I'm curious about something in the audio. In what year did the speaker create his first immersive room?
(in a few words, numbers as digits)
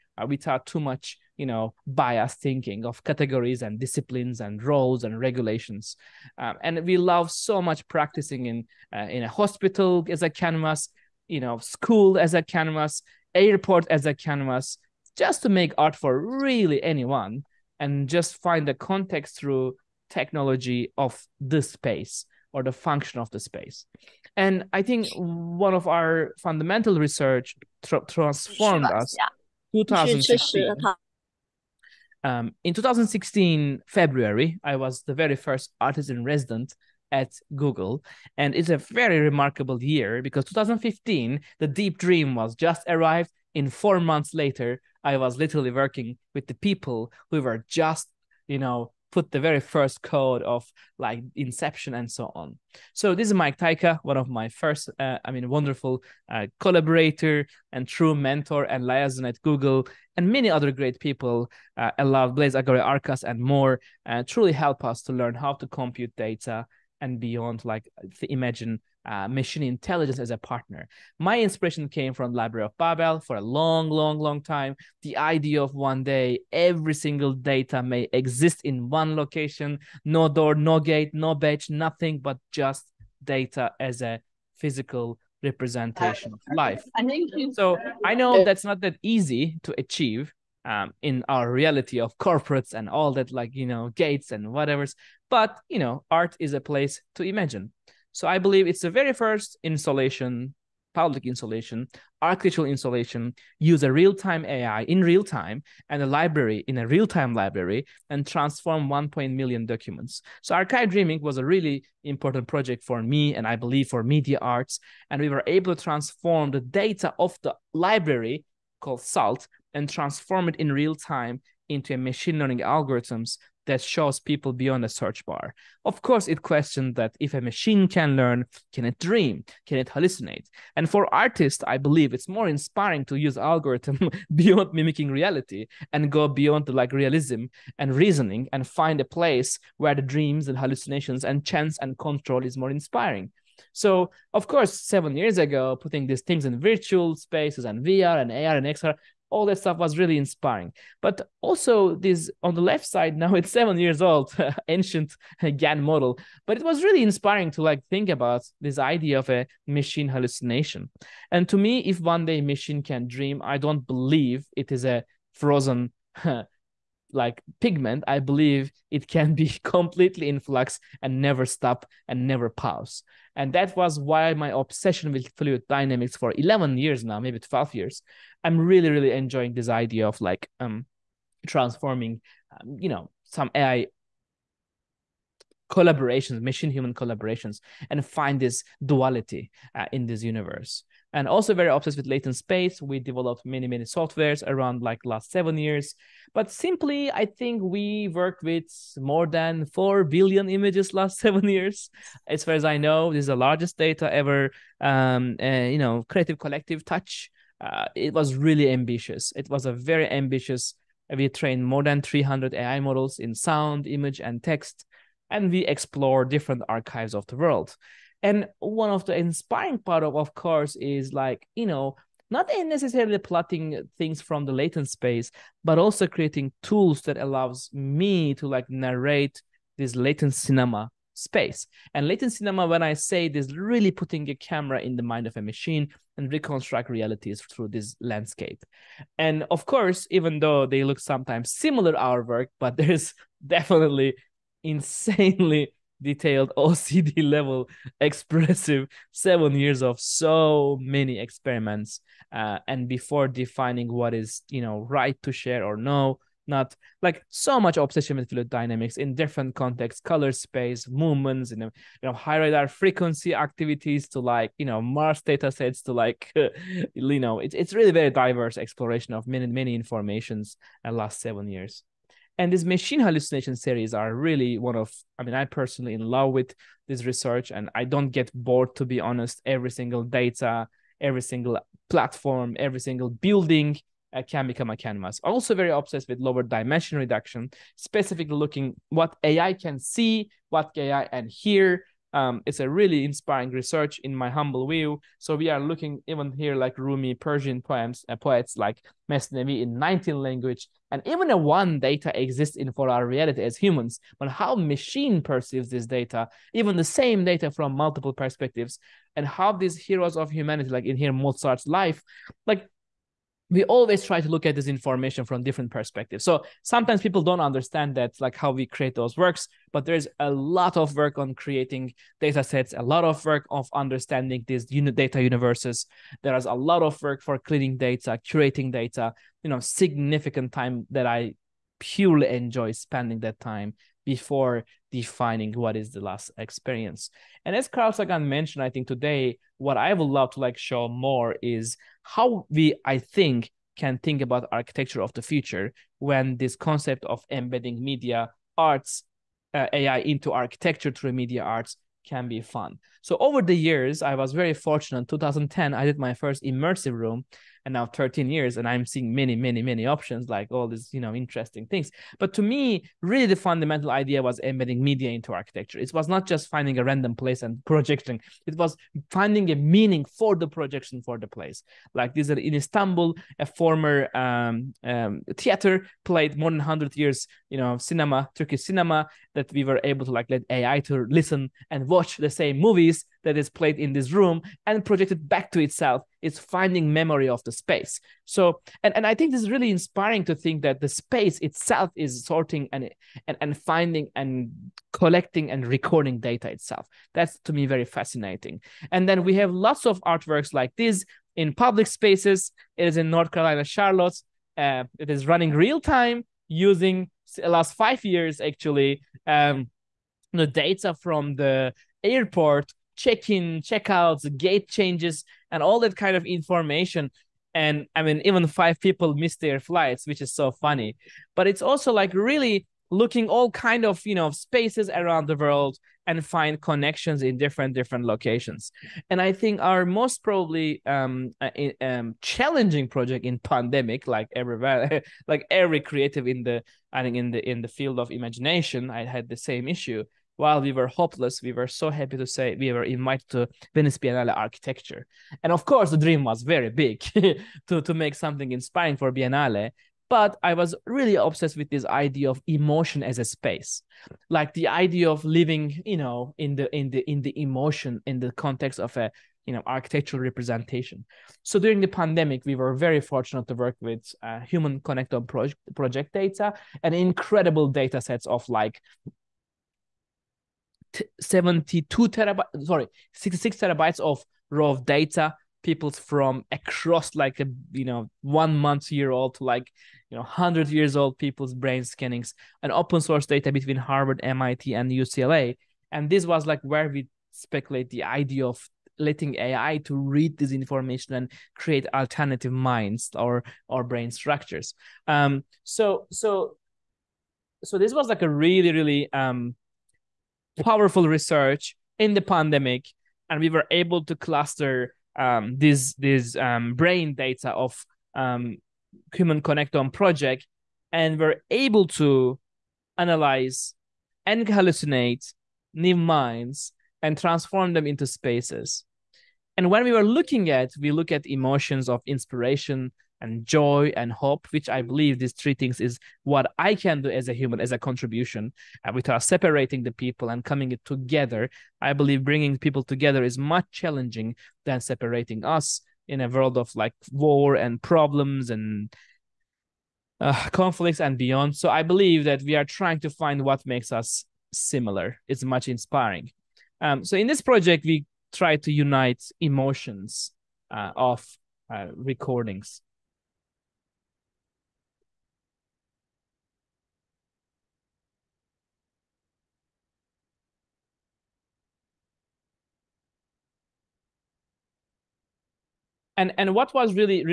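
2010.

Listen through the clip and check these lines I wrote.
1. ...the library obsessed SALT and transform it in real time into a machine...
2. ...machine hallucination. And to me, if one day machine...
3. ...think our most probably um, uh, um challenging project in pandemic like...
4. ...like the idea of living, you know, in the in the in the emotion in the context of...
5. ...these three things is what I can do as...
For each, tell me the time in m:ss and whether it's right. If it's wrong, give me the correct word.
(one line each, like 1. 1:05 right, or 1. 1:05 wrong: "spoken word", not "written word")
1. 1:57 wrong: "called", not "obsessed"
2. 2:39 right
3. 7:09 right
4. 7:34 right
5. 8:45 right.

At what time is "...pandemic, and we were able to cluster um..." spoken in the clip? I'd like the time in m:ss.
8:22.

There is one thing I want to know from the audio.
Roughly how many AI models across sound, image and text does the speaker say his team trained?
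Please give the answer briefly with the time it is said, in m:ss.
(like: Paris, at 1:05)
300, at 3:32.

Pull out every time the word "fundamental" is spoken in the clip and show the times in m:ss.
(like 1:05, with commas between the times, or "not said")
0:26, 6:03.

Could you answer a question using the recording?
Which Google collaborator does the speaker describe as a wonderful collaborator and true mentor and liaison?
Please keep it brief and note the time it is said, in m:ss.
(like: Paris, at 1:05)
Mike Tyka, at 0:53.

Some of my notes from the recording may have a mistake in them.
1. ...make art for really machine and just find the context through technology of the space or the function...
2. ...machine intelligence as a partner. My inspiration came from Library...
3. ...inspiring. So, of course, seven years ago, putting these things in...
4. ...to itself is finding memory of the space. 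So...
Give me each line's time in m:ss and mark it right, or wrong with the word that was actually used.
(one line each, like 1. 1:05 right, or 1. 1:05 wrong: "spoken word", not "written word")
1. 0:15 wrong: "anyone", not "machine"
2. 1:09 right
3. 2:22 right
4. 6:25 right.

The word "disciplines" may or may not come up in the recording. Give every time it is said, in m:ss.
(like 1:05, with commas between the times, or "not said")
0:03.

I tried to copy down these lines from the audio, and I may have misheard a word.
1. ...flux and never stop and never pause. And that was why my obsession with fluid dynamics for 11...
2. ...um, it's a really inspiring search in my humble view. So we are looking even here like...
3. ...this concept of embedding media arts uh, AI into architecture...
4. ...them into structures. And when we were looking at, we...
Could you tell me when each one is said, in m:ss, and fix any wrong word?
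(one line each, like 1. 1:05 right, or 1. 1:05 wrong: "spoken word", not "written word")
1. 2:50 right
2. 4:52 wrong: "research", not "search"
3. 5:46 right
4. 8:37 wrong: "spaces", not "structures".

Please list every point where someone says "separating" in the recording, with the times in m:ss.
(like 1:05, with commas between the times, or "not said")
8:49, 8:54.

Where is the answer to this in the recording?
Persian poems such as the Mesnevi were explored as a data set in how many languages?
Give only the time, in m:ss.
4:59.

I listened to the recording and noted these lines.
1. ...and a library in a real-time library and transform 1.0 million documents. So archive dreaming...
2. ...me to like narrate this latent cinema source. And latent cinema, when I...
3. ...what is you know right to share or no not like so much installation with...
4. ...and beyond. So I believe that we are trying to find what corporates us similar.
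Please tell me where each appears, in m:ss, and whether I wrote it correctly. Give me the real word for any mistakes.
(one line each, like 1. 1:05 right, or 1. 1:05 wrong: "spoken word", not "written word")
1. 1:45 right
2. 3:47 wrong: "space", not "source"
3. 4:13 wrong: "obsession", not "installation"
4. 9:01 wrong: "makes", not "corporates".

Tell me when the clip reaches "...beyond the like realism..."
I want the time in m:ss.
2:16.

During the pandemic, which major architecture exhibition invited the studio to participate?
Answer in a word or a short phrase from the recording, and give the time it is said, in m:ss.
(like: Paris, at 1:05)
Venice Biennale Architecture, at 7:23.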